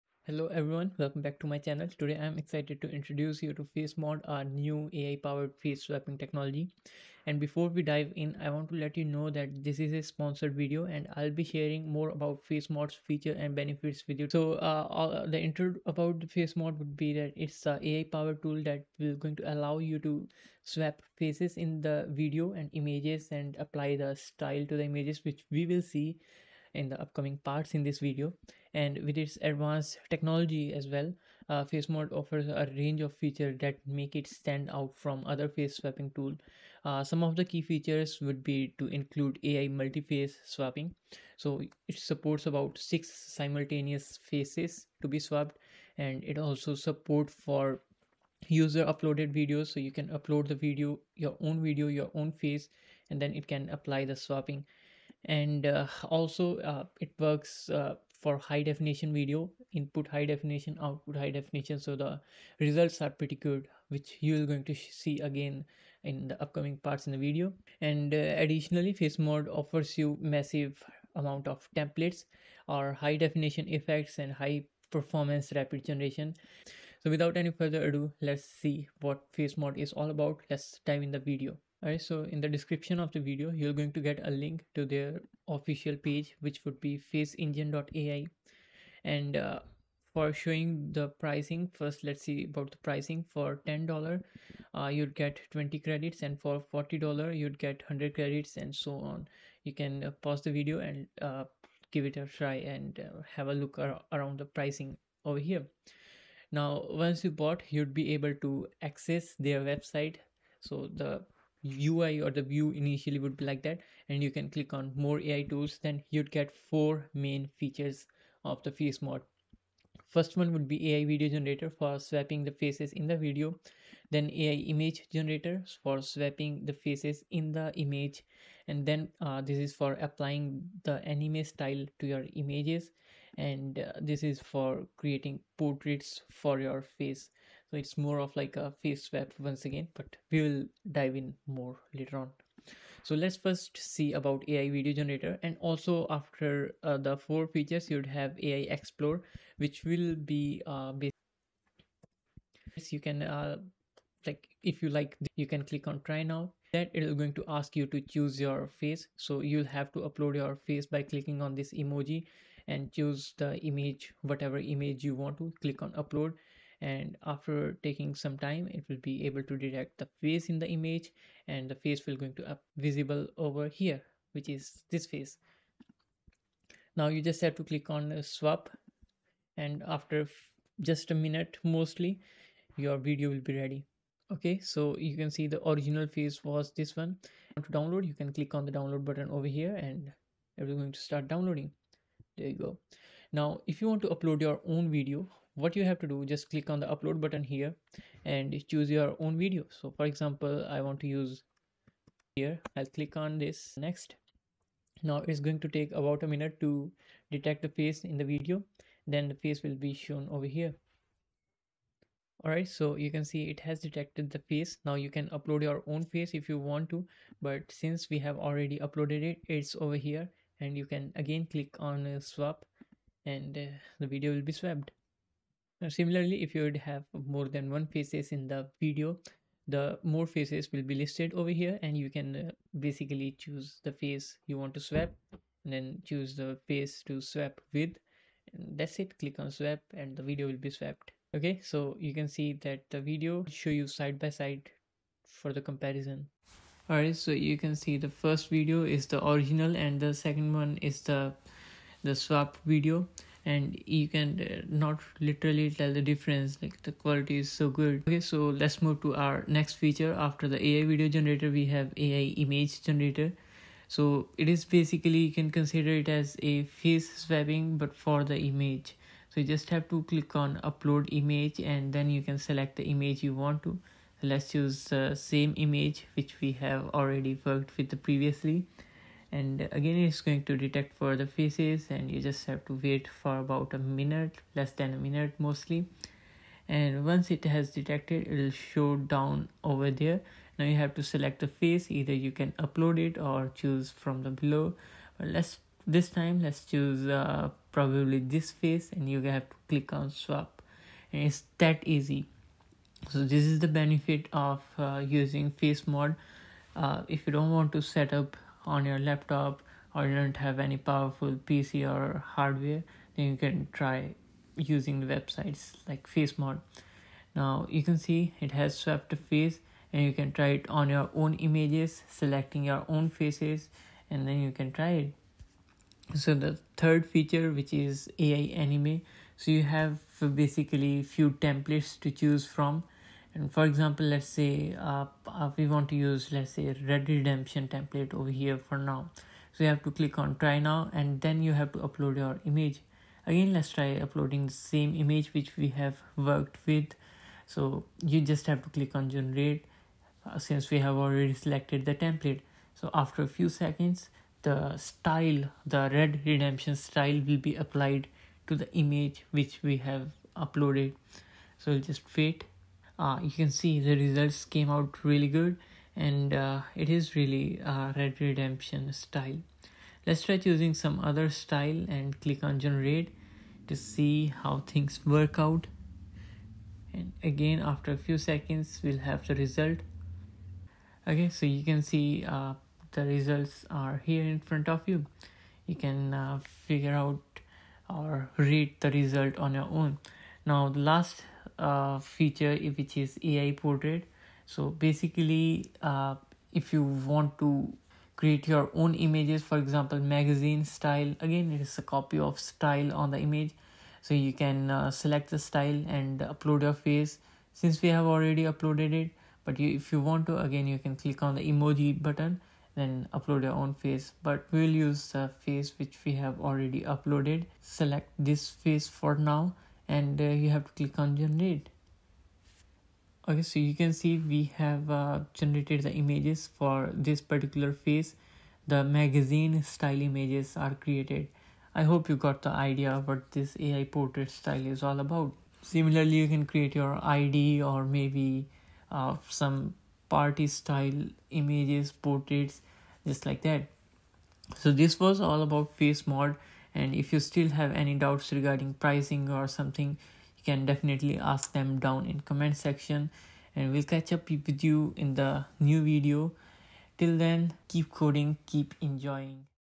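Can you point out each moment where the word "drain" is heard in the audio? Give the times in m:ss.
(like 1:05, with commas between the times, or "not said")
not said.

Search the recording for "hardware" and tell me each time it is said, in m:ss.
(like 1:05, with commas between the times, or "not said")
5:12.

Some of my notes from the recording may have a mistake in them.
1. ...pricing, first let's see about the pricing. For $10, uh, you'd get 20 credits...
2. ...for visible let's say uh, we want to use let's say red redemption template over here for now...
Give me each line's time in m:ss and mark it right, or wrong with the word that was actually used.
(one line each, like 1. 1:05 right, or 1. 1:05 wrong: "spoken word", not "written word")
1. 1:31 right
2. 5:33 wrong: "example", not "visible".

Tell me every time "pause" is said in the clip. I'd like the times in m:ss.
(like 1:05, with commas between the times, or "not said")
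1:40.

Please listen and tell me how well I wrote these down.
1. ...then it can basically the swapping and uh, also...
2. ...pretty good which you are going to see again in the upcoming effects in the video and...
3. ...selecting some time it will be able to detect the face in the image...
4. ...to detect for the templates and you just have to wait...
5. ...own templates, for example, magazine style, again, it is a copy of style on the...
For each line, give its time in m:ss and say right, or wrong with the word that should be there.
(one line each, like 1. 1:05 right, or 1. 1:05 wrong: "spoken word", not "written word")
1. 0:53 wrong: "apply", not "basically"
2. 1:03 wrong: "parts", not "effects"
3. 2:47 wrong: "taking", not "selecting"
4. 4:40 wrong: "faces", not "templates"
5. 6:38 wrong: "images", not "templates".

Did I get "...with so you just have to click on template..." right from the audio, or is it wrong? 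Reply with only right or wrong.
wrong.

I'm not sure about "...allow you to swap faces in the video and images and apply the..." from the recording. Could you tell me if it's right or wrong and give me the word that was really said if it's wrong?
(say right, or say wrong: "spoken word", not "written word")
right.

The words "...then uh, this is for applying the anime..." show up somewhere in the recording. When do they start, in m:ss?
2:08.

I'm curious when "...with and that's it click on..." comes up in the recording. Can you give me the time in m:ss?
3:57.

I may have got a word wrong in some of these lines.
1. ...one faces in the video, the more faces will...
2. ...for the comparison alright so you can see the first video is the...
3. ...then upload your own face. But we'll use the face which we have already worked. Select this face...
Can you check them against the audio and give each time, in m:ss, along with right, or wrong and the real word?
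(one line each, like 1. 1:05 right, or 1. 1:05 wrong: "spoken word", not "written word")
1. 3:47 right
2. 4:05 right
3. 6:52 wrong: "uploaded", not "worked".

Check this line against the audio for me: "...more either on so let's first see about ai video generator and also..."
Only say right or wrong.
wrong.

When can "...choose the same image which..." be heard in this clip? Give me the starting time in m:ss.
4:34.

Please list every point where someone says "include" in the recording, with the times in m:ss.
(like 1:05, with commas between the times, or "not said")
0:38.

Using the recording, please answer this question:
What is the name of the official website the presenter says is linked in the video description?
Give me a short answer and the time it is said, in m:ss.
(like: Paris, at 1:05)
faceengine.ai, at 1:27.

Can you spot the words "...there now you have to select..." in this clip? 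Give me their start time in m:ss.
4:49.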